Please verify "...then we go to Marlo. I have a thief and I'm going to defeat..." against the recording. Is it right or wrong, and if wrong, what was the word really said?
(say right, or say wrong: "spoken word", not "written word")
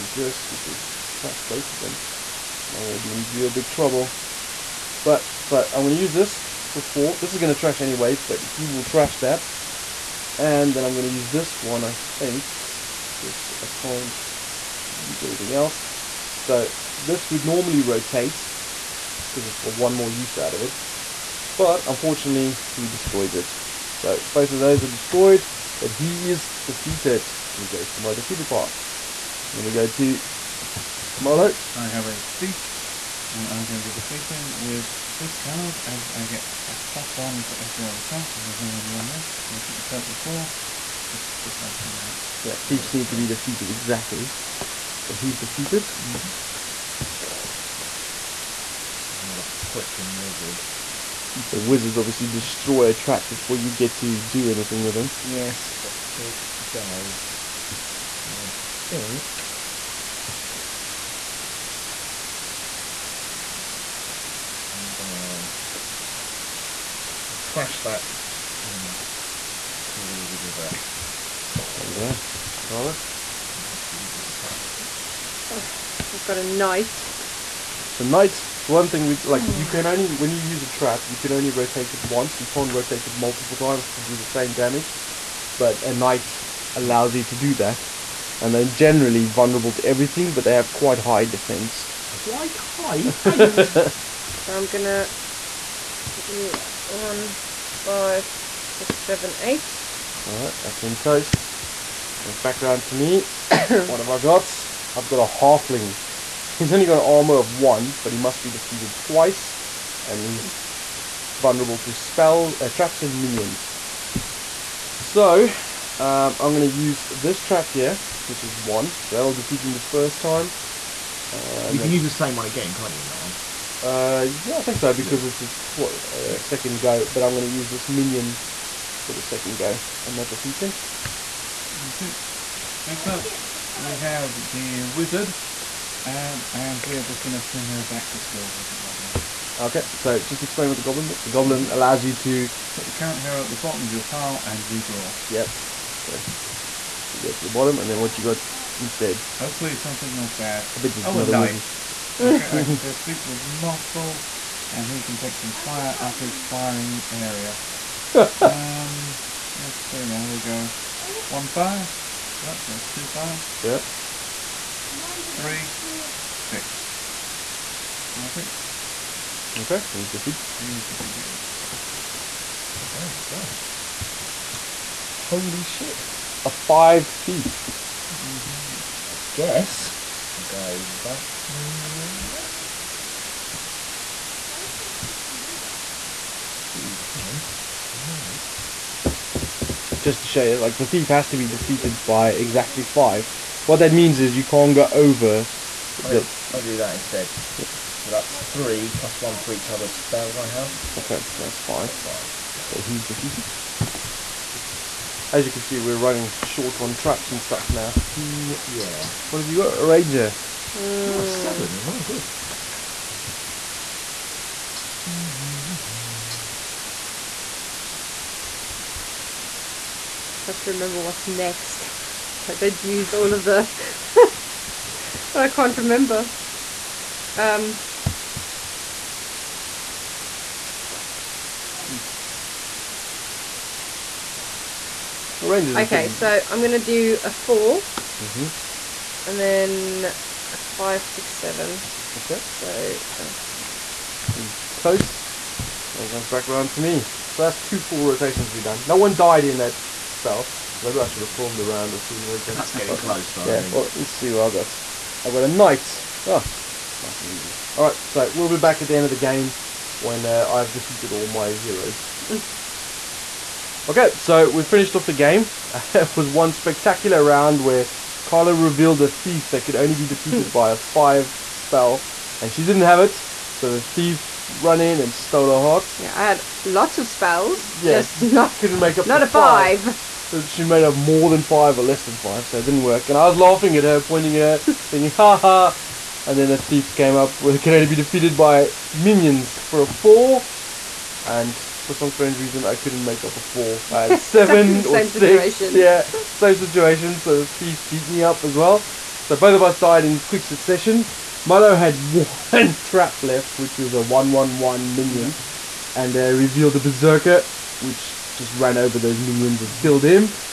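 right.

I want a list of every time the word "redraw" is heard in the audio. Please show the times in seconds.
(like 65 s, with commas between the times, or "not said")
144 s.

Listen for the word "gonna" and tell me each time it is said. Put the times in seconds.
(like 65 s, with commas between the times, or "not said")
64 s, 94 s.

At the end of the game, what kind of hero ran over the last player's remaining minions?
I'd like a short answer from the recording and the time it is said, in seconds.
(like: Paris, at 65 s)
Berserker, at 306 s.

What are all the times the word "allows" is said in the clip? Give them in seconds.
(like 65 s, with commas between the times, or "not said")
86 s, 141 s.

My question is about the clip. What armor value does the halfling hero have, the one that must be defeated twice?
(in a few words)
1.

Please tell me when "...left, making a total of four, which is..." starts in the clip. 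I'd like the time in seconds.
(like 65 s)
39 s.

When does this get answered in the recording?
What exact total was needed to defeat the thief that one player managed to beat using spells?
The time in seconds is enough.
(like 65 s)
192 s.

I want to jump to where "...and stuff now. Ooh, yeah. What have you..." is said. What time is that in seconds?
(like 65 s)
207 s.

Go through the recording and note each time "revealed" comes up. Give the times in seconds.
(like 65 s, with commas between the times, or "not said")
268 s, 306 s.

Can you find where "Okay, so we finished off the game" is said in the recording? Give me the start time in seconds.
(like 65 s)
263 s.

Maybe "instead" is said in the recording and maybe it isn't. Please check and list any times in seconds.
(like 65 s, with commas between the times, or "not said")
148 s, 196 s.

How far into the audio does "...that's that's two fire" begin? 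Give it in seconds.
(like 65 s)
162 s.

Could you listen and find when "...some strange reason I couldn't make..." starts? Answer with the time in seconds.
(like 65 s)
291 s.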